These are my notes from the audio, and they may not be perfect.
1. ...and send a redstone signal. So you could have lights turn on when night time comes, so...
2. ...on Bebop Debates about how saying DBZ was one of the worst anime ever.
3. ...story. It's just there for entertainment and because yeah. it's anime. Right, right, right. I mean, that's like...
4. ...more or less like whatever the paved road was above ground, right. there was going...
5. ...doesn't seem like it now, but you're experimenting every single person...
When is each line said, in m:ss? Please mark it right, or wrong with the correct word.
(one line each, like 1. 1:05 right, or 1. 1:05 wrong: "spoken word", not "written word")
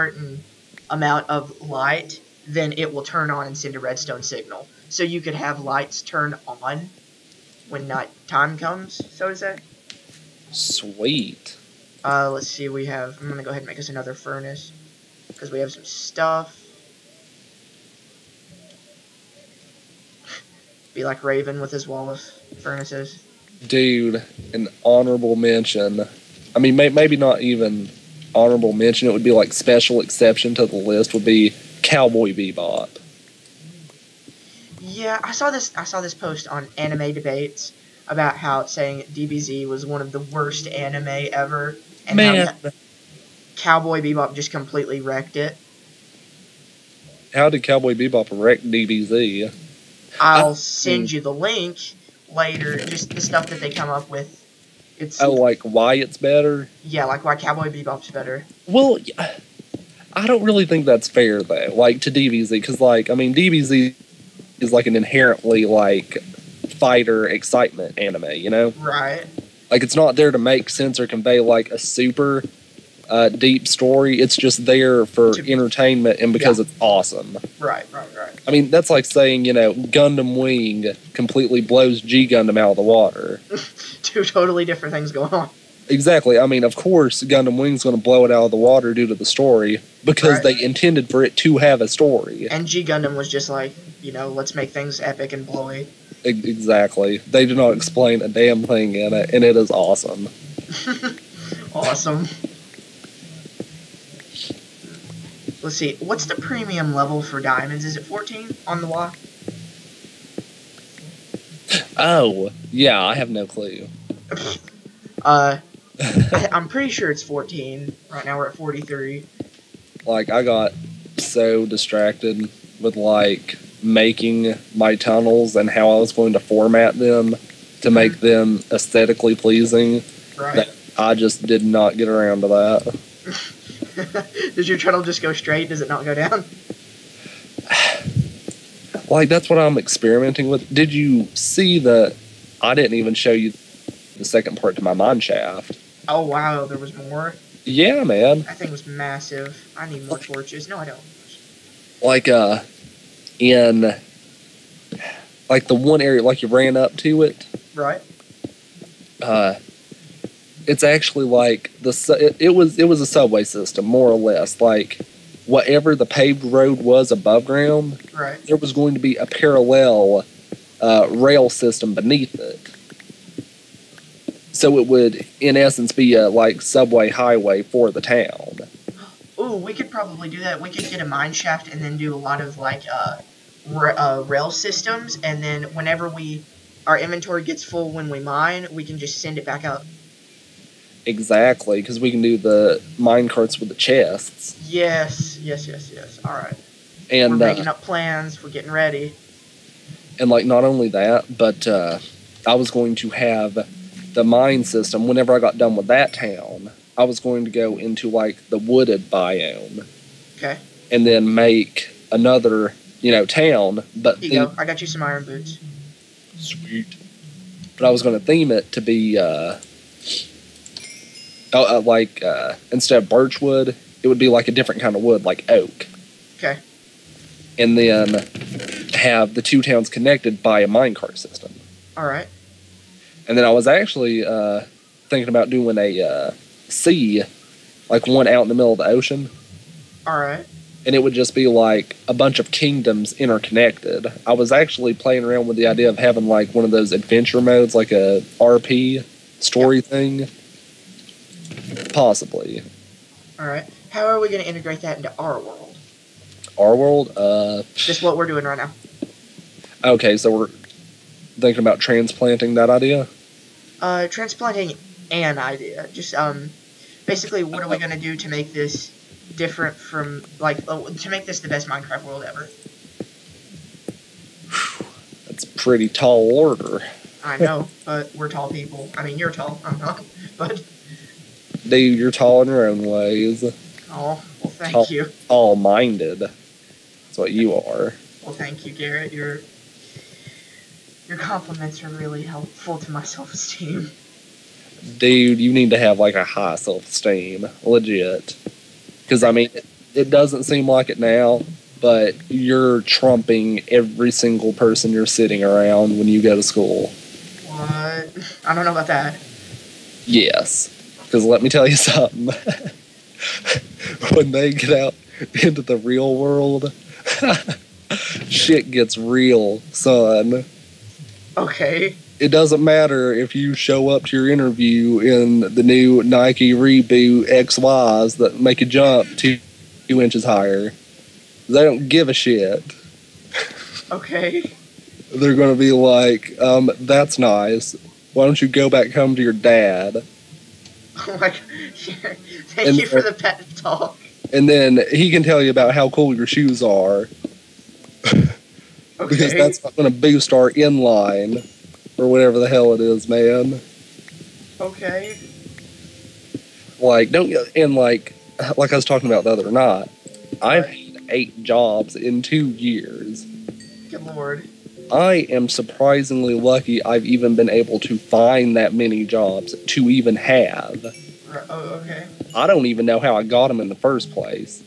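1. 0:03 right
2. 0:36 wrong: "Anime", not "Bebop"
3. 1:13 wrong: "awesome", not "anime"
4. 2:43 right
5. 5:00 wrong: "trumping", not "experimenting".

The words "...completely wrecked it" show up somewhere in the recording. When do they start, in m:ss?
0:44.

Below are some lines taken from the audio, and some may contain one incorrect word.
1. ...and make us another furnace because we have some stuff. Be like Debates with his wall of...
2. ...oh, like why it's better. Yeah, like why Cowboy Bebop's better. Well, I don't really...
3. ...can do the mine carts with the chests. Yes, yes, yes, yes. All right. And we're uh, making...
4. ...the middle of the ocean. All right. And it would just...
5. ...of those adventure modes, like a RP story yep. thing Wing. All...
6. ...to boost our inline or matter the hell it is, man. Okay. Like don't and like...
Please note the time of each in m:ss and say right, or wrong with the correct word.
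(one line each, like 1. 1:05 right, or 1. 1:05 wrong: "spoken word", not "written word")
1. 0:13 wrong: "Raven", not "Debates"
2. 0:55 right
3. 3:12 right
4. 3:58 right
5. 4:06 wrong: "Possibly", not "Wing"
6. 5:49 wrong: "whatever", not "matter".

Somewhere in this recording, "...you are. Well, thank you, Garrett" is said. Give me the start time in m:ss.
4:47.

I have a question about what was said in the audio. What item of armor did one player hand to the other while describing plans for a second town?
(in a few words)
iron boots.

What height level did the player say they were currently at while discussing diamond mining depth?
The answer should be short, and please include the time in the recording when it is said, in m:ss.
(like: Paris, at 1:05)
43, at 1:58.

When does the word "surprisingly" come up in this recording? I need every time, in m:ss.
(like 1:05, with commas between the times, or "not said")
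6:05.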